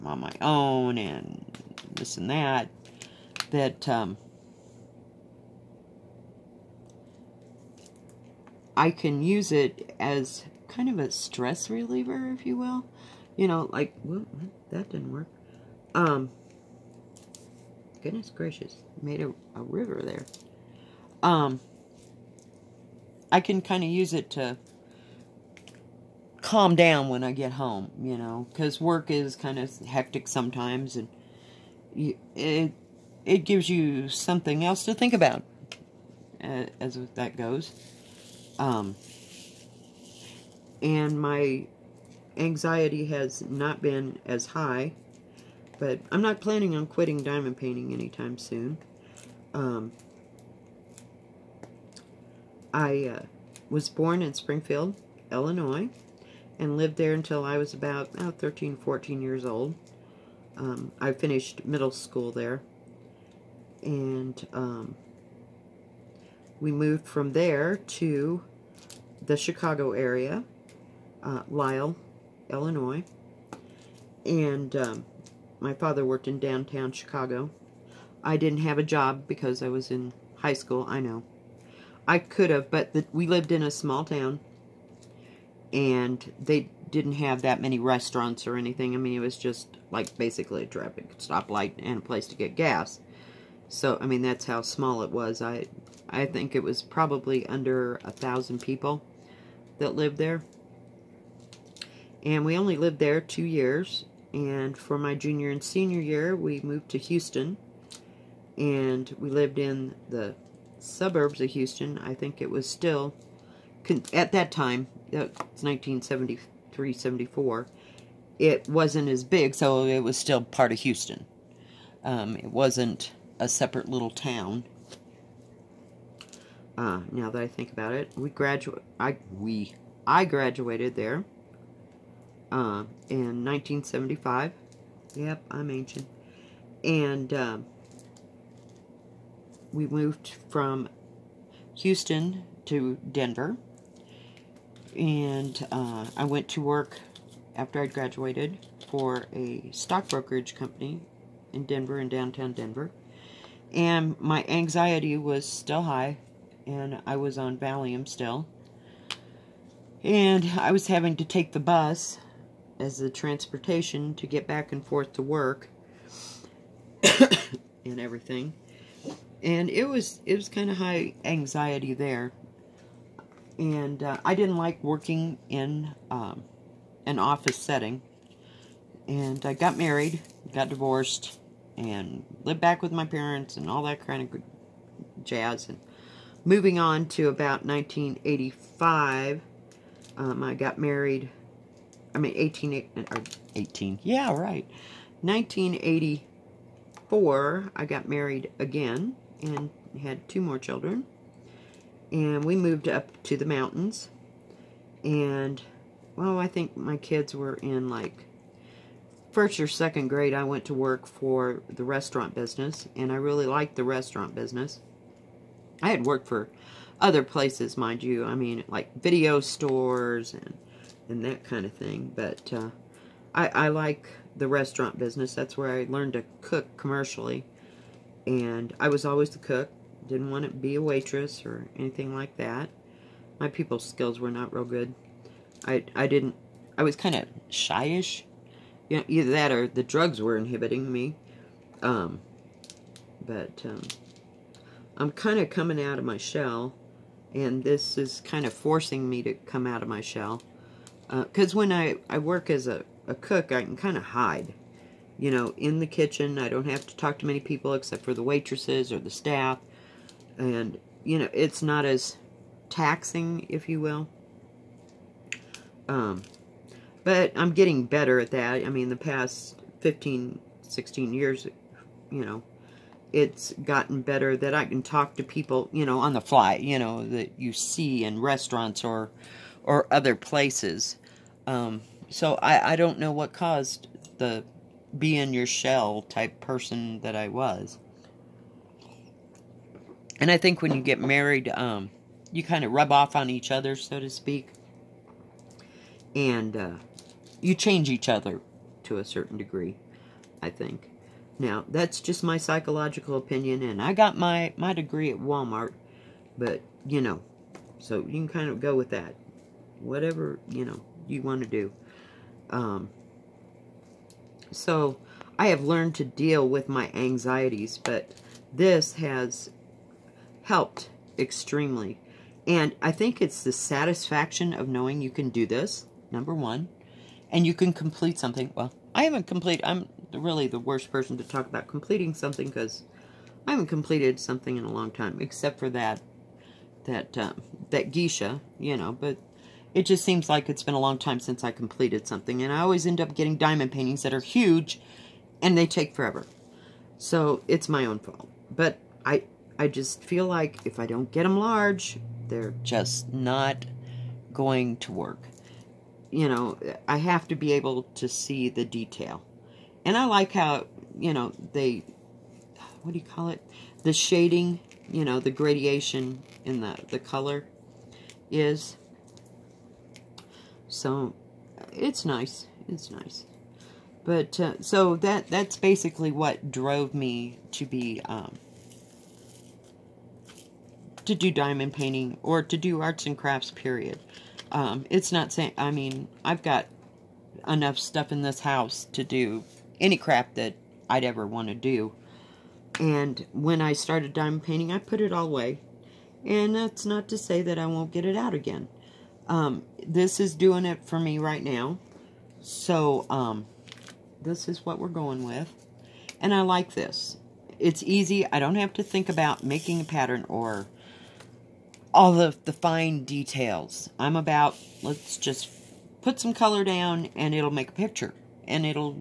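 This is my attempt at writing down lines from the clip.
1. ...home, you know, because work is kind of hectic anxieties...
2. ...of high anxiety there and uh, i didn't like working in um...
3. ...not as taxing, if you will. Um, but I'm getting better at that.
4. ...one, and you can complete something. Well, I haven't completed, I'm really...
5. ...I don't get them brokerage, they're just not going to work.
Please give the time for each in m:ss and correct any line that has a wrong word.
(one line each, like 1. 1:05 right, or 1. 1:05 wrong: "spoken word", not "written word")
1. 0:27 wrong: "sometimes", not "anxieties"
2. 2:50 right
3. 4:21 right
4. 5:26 right
5. 5:50 wrong: "large", not "brokerage".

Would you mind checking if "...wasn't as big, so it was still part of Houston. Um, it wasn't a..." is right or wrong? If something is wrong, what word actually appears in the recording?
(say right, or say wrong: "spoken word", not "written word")
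right.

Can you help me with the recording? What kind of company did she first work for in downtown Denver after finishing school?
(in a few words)
stock brokerage company.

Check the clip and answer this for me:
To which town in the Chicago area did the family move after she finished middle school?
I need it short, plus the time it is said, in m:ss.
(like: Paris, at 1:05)
Lisle, Illinois, at 1:11.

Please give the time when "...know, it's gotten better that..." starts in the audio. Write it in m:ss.
4:32.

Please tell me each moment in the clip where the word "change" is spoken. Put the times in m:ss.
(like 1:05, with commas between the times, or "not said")
4:57.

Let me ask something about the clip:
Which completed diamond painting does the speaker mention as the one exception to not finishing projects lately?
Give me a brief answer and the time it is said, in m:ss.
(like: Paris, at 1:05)
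geisha, at 5:37.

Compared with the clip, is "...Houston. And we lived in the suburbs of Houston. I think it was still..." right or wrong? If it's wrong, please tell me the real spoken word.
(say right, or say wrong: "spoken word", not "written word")
right.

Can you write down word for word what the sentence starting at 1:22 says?
I could have, but the, we lived in a small town, and they didn't have that many restaurants or anything.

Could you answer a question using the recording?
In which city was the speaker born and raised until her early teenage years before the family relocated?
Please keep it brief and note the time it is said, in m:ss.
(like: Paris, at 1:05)
Springfield, Illinois, at 0:54.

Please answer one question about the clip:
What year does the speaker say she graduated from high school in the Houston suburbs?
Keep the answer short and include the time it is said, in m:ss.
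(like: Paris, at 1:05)
1975, at 2:13.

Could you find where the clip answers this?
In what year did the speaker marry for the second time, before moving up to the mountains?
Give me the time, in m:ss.
3:15.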